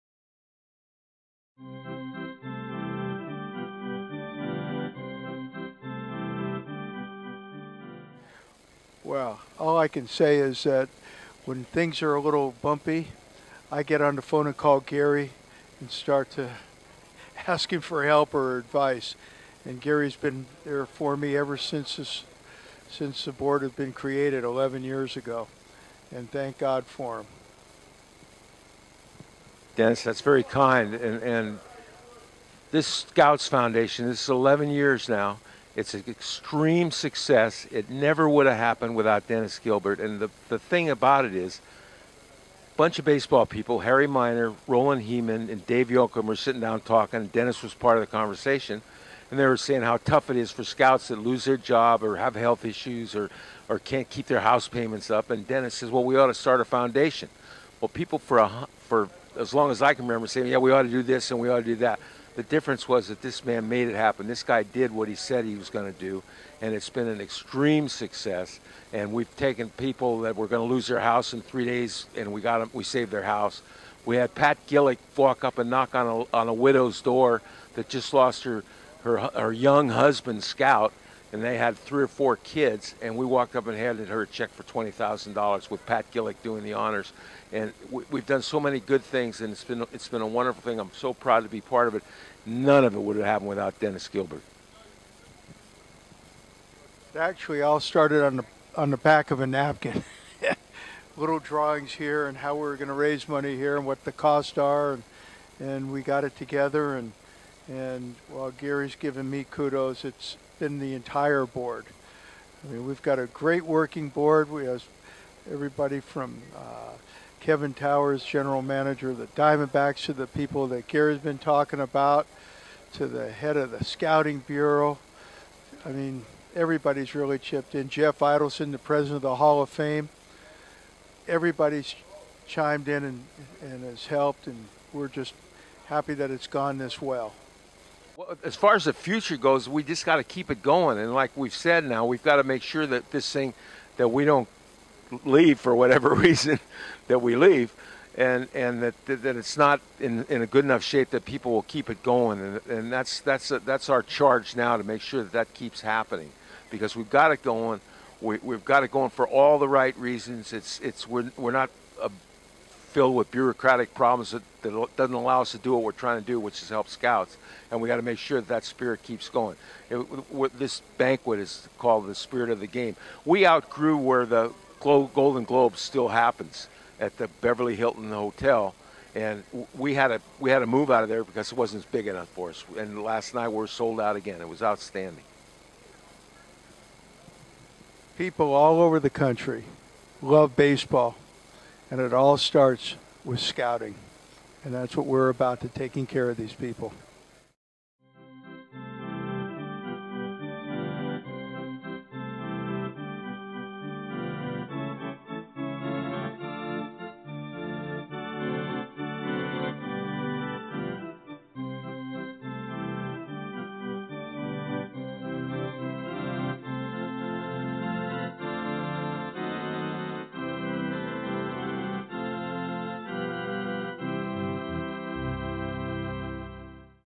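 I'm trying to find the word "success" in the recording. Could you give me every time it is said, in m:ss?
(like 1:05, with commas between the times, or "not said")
0:36, 1:07.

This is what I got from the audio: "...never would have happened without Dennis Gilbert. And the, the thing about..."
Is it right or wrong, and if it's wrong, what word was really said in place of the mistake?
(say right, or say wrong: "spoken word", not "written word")
right.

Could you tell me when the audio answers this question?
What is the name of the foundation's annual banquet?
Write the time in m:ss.
2:52.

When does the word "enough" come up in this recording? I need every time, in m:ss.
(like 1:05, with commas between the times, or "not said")
2:30, 3:02.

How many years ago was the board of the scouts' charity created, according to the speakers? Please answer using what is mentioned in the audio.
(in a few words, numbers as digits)
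11.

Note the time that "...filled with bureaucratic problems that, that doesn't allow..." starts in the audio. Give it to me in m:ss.
2:42.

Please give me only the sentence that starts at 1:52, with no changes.
I mean, we've got a great working board.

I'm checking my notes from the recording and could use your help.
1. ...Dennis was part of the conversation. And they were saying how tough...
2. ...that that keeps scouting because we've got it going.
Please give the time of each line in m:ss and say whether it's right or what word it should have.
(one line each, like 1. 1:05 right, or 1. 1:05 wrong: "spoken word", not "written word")
1. 0:47 right
2. 2:35 wrong: "happening", not "scouting".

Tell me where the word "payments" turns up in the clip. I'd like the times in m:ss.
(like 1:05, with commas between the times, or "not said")
0:54.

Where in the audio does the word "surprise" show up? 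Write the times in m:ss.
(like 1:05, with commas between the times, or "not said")
not said.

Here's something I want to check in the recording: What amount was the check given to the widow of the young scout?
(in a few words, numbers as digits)
$20,000.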